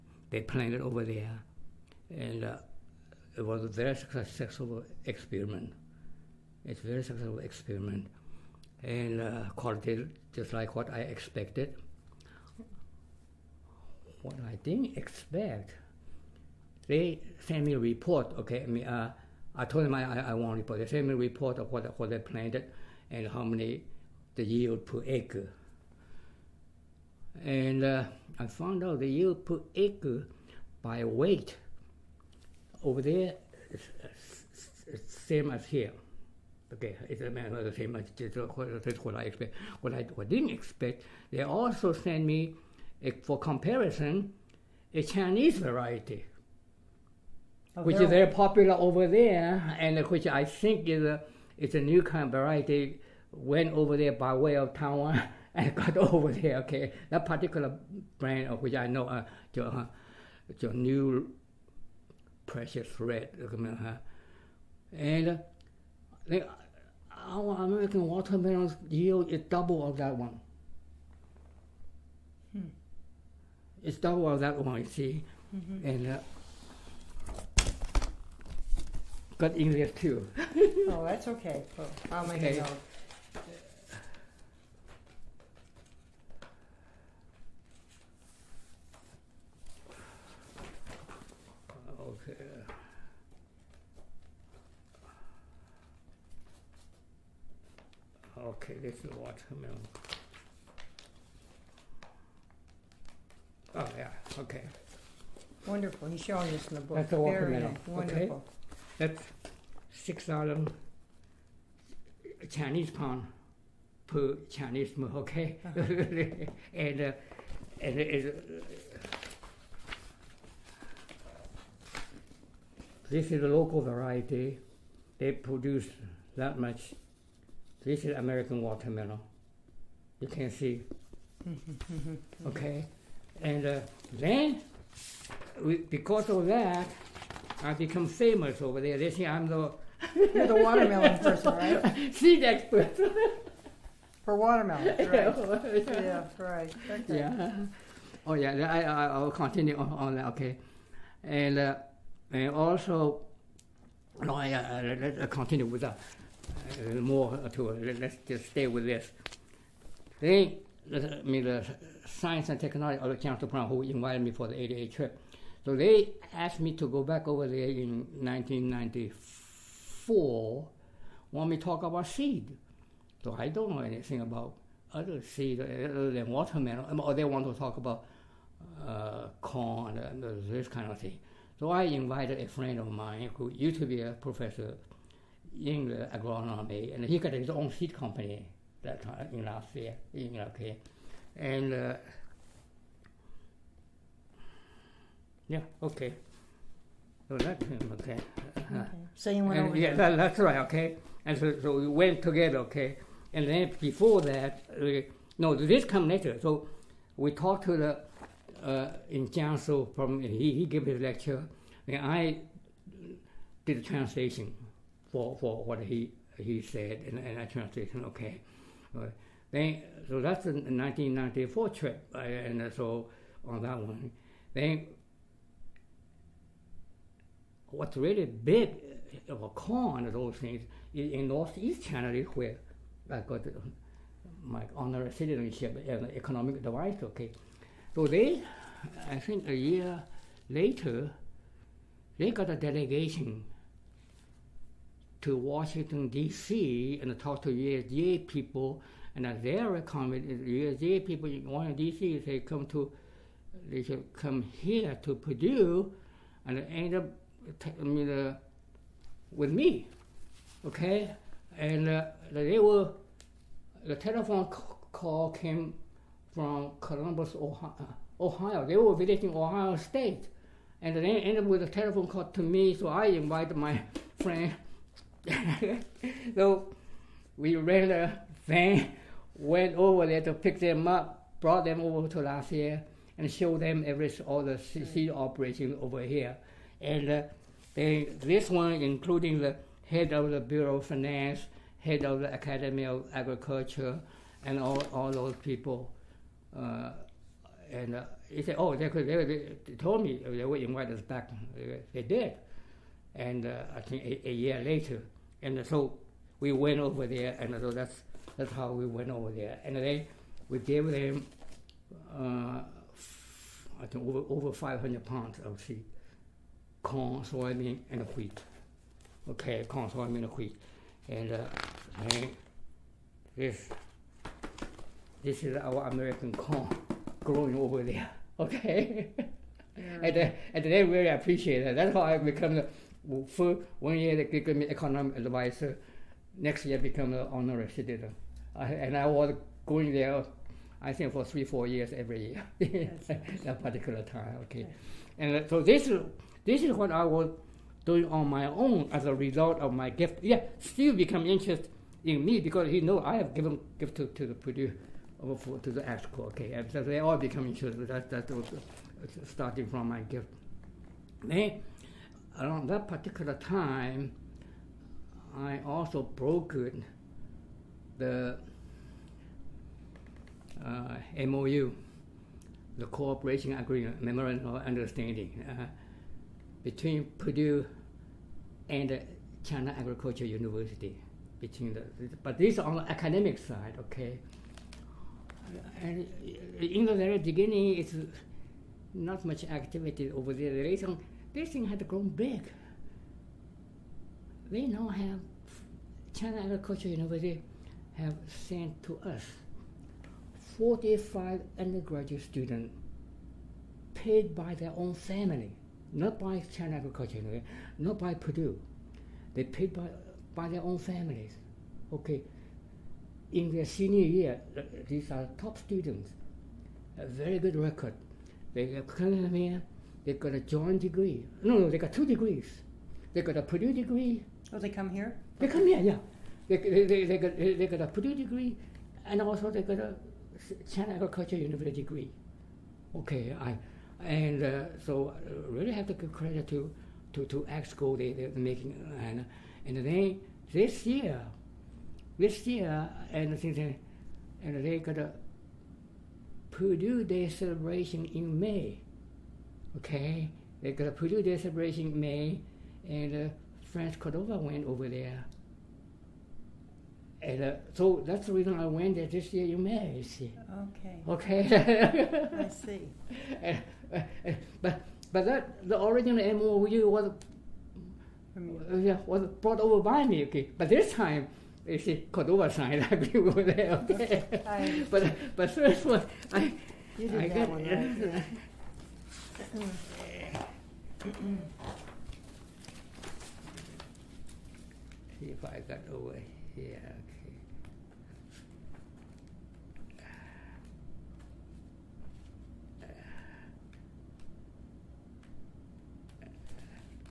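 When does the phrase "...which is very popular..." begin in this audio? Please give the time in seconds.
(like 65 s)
47 s.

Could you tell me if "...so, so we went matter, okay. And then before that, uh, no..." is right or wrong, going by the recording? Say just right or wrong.
wrong.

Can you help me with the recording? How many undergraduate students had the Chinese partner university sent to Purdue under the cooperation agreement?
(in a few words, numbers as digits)
45.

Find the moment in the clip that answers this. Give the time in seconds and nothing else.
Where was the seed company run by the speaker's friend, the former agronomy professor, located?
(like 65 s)
189 s.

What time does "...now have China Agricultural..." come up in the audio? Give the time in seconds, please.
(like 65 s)
394 s.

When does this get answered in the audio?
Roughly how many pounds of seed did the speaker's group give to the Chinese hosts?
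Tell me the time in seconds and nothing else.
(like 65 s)
314 s.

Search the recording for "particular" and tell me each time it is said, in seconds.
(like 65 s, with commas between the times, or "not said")
57 s, 343 s, 362 s.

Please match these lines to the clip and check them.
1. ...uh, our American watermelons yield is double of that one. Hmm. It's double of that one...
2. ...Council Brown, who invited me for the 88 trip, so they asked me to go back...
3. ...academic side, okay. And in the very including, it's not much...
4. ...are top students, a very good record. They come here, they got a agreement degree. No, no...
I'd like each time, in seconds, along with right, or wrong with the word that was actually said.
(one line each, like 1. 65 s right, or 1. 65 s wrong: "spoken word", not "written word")
1. 66 s right
2. 163 s right
3. 382 s wrong: "beginning", not "including"
4. 415 s wrong: "joint", not "agreement".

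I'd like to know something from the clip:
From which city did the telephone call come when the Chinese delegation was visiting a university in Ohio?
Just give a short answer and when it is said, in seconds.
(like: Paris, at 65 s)
Columbus, at 266 s.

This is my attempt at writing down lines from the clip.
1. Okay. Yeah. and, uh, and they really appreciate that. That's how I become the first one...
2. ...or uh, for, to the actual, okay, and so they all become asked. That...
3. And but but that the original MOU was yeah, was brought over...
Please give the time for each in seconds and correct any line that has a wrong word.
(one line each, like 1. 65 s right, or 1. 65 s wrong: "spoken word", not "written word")
1. 328 s right
2. 355 s wrong: "interested", not "asked"
3. 463 s right.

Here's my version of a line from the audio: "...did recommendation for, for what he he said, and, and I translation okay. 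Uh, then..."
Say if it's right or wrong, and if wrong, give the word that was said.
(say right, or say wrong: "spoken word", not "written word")
wrong: "translation", not "recommendation".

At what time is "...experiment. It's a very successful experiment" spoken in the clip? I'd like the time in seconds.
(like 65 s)
5 s.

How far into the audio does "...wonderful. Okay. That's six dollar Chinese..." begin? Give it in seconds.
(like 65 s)
107 s.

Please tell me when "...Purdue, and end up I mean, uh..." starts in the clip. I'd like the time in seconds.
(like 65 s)
255 s.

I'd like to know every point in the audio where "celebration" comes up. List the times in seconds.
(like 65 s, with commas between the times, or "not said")
447 s, 451 s.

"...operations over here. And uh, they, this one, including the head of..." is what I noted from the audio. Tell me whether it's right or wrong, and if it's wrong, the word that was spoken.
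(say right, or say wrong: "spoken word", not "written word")
right.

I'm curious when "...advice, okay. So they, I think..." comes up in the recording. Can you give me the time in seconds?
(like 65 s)
236 s.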